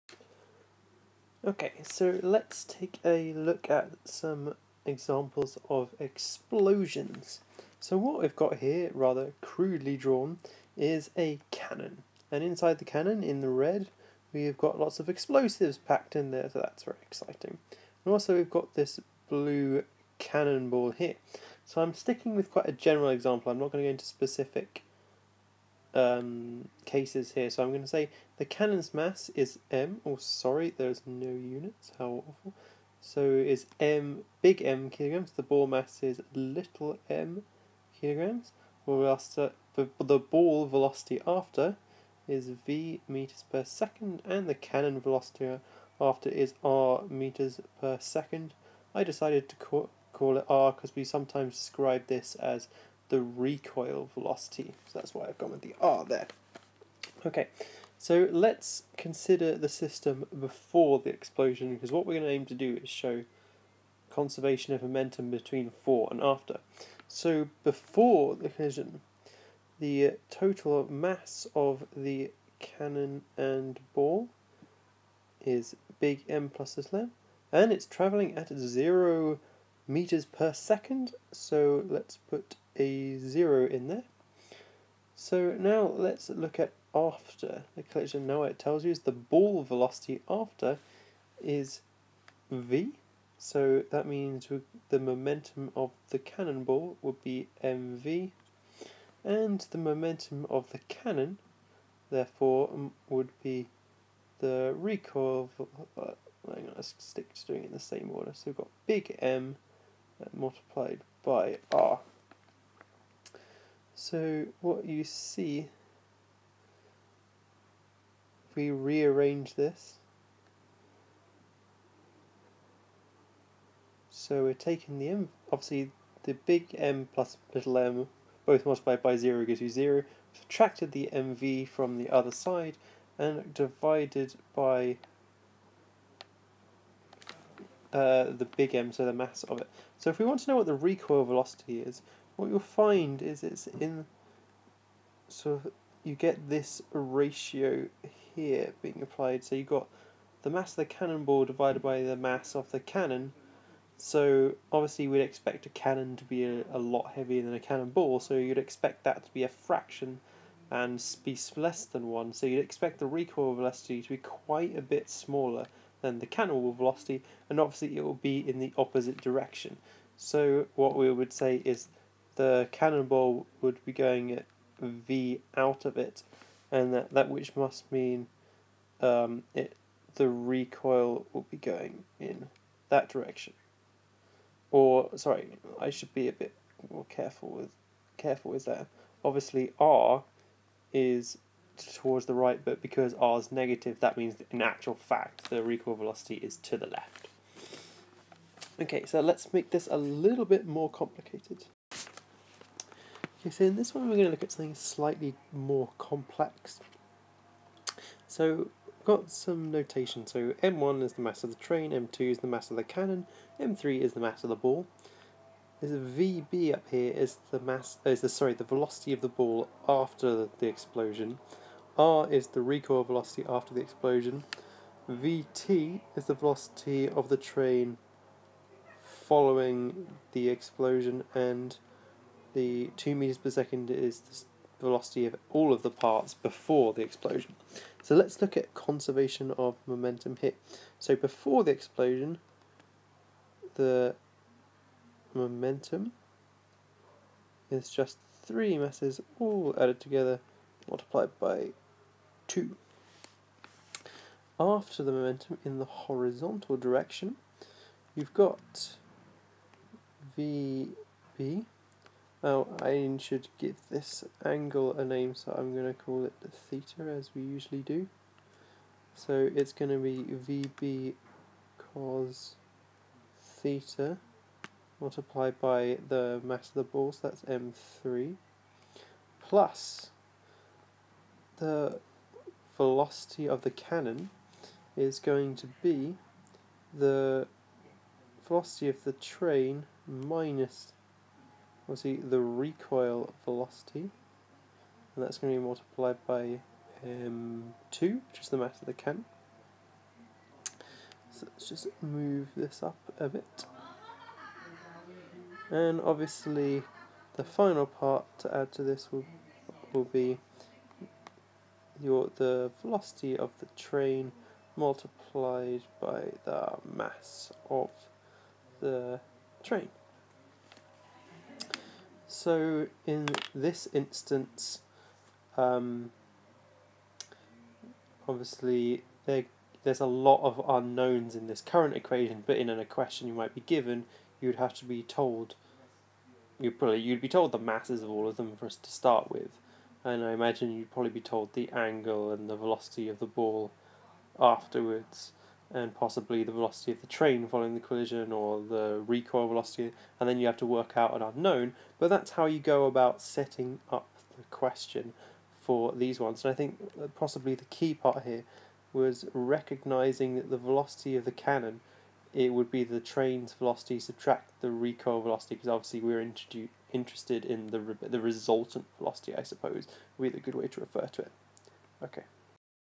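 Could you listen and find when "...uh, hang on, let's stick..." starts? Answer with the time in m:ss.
1:45.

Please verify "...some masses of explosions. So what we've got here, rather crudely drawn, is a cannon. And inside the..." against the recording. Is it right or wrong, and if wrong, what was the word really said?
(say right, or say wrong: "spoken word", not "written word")
wrong: "examples", not "masses".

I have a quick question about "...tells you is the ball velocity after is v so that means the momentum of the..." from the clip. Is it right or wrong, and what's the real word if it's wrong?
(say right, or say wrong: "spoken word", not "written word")
right.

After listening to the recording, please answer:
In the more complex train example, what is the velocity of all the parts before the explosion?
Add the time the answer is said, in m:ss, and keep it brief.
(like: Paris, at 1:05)
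2 meters per second, at 3:52.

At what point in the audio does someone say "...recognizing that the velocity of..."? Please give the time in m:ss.
5:59.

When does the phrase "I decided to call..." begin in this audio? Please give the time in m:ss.
0:48.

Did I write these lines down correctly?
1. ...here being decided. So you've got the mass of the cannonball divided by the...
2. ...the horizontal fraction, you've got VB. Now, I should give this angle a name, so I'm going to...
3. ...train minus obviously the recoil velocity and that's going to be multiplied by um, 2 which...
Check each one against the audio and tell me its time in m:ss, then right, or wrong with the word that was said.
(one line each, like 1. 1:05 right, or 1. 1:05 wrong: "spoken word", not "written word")
1. 2:28 wrong: "applied", not "decided"
2. 4:15 wrong: "direction", not "fraction"
3. 4:49 right.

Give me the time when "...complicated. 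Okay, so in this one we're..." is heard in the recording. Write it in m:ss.
3:20.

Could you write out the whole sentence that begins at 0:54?
So that's why I've gone with the R there.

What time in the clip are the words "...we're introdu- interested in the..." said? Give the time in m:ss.
6:05.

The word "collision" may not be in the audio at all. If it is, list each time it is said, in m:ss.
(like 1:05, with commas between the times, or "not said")
1:08, 1:27, 5:47.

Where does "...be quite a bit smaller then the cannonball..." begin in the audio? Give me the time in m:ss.
2:44.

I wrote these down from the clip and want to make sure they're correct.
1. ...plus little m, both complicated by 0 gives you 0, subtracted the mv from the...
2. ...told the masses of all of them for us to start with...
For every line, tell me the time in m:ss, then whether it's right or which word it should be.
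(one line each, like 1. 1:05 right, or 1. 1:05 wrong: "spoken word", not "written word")
1. 2:07 wrong: "multiplied", not "complicated"
2. 5:37 right.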